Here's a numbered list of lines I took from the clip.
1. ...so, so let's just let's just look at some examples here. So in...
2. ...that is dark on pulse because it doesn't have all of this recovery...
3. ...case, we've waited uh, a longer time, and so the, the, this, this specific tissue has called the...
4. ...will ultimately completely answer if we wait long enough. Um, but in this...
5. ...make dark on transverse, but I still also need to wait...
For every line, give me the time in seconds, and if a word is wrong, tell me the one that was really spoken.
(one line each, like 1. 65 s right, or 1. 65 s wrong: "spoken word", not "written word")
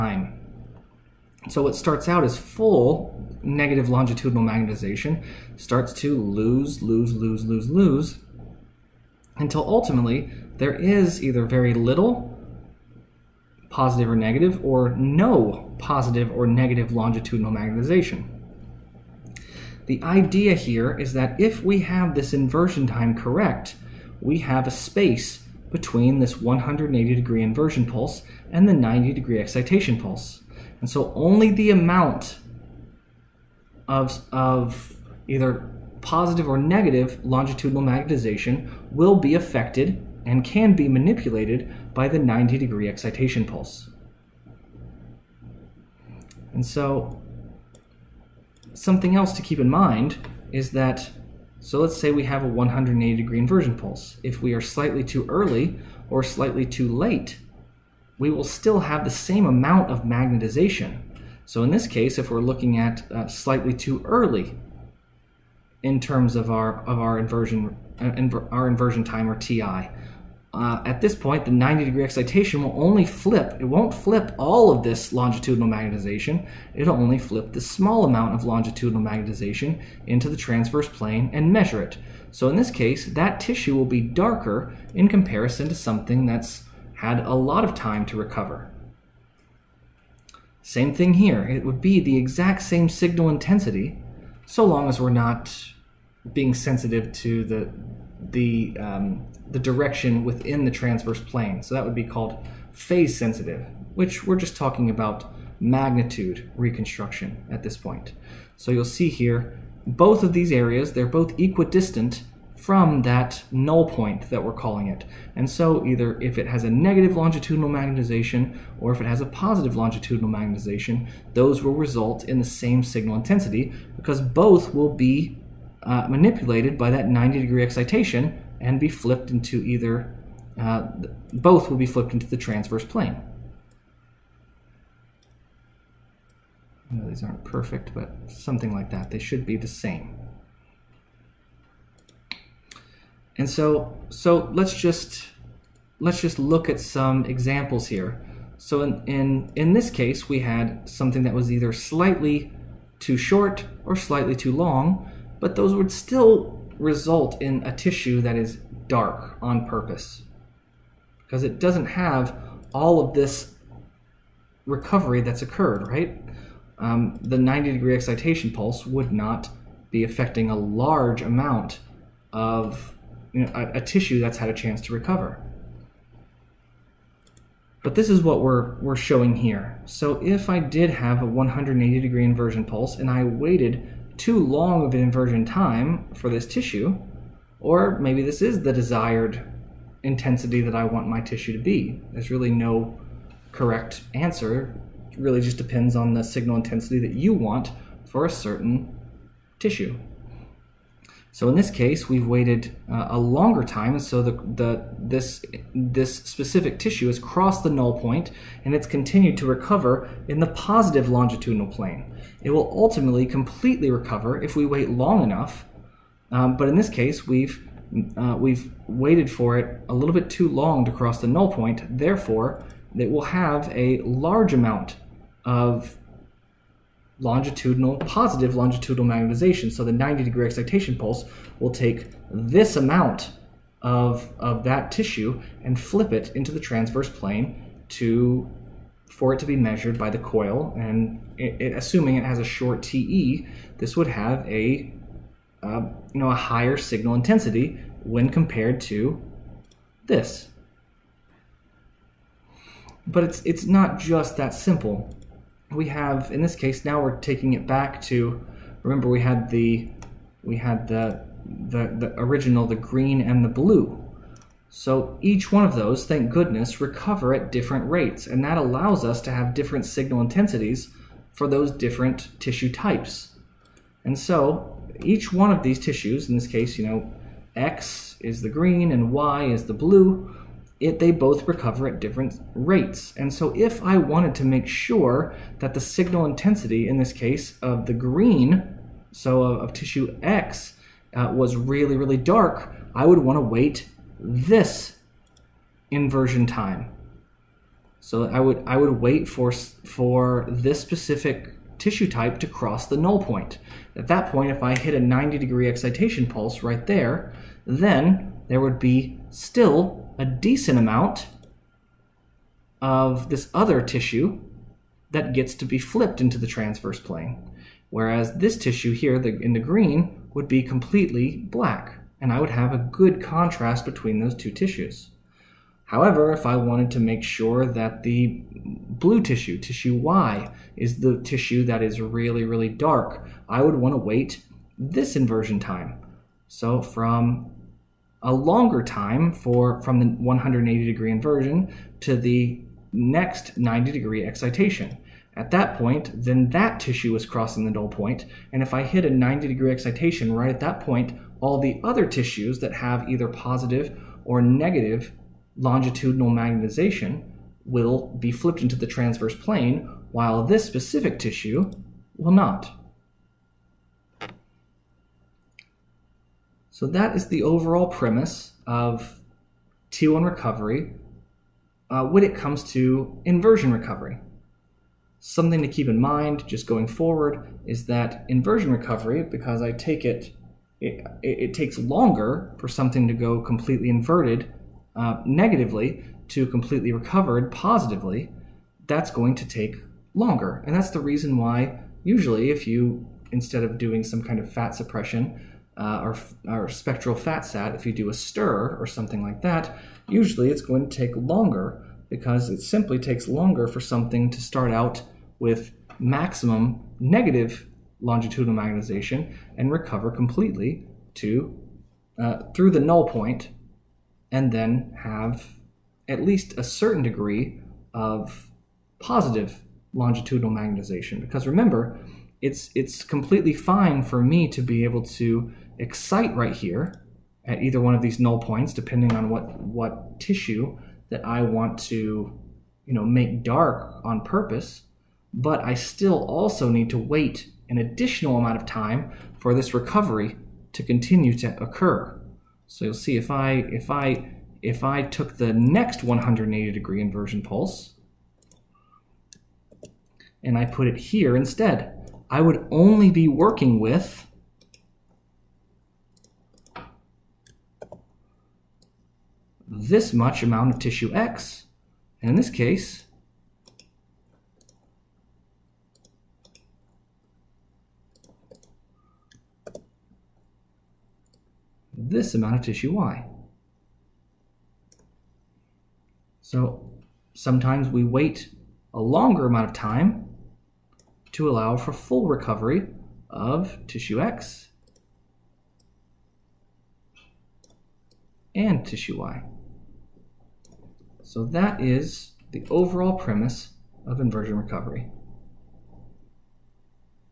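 1. 143 s right
2. 158 s wrong: "purpose", not "pulse"
3. 201 s wrong: "crossed", not "called"
4. 212 s wrong: "recover", not "answer"
5. 433 s wrong: "purpose", not "transverse".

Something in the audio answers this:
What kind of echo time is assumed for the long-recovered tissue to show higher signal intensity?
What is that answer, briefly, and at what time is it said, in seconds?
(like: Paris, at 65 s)
Short TE, at 242 s.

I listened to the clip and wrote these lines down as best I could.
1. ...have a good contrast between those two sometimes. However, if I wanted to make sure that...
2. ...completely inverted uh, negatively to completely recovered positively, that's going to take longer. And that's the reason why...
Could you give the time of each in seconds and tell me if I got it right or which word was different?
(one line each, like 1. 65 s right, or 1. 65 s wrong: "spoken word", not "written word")
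1. 322 s wrong: "tissues", not "sometimes"
2. 383 s right.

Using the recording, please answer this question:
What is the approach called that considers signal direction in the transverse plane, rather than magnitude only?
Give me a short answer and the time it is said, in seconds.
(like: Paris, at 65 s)
Phase sensitive, at 102 s.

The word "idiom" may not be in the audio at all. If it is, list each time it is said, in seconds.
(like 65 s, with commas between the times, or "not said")
not said.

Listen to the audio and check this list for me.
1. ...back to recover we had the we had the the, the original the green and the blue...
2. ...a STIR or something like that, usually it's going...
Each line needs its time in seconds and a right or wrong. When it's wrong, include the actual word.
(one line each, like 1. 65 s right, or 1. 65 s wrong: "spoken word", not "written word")
1. 257 s wrong: "remember", not "recover"
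2. 398 s right.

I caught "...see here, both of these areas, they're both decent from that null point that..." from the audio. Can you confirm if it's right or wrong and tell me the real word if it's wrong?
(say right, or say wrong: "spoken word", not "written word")
wrong: "equidistant", not "decent".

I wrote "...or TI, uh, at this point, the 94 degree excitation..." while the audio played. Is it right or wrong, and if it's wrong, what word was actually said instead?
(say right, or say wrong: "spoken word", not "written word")
wrong: "90", not "94".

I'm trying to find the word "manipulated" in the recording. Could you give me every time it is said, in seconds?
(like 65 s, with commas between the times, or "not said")
40 s, 126 s.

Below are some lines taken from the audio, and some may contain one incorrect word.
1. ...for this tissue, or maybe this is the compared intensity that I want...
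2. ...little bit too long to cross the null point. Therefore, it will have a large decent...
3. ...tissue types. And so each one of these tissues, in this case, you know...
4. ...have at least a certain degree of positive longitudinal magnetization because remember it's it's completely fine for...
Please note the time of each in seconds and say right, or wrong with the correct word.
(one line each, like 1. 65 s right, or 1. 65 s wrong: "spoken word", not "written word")
1. 186 s wrong: "desired", not "compared"
2. 219 s wrong: "amount", not "decent"
3. 272 s right
4. 415 s right.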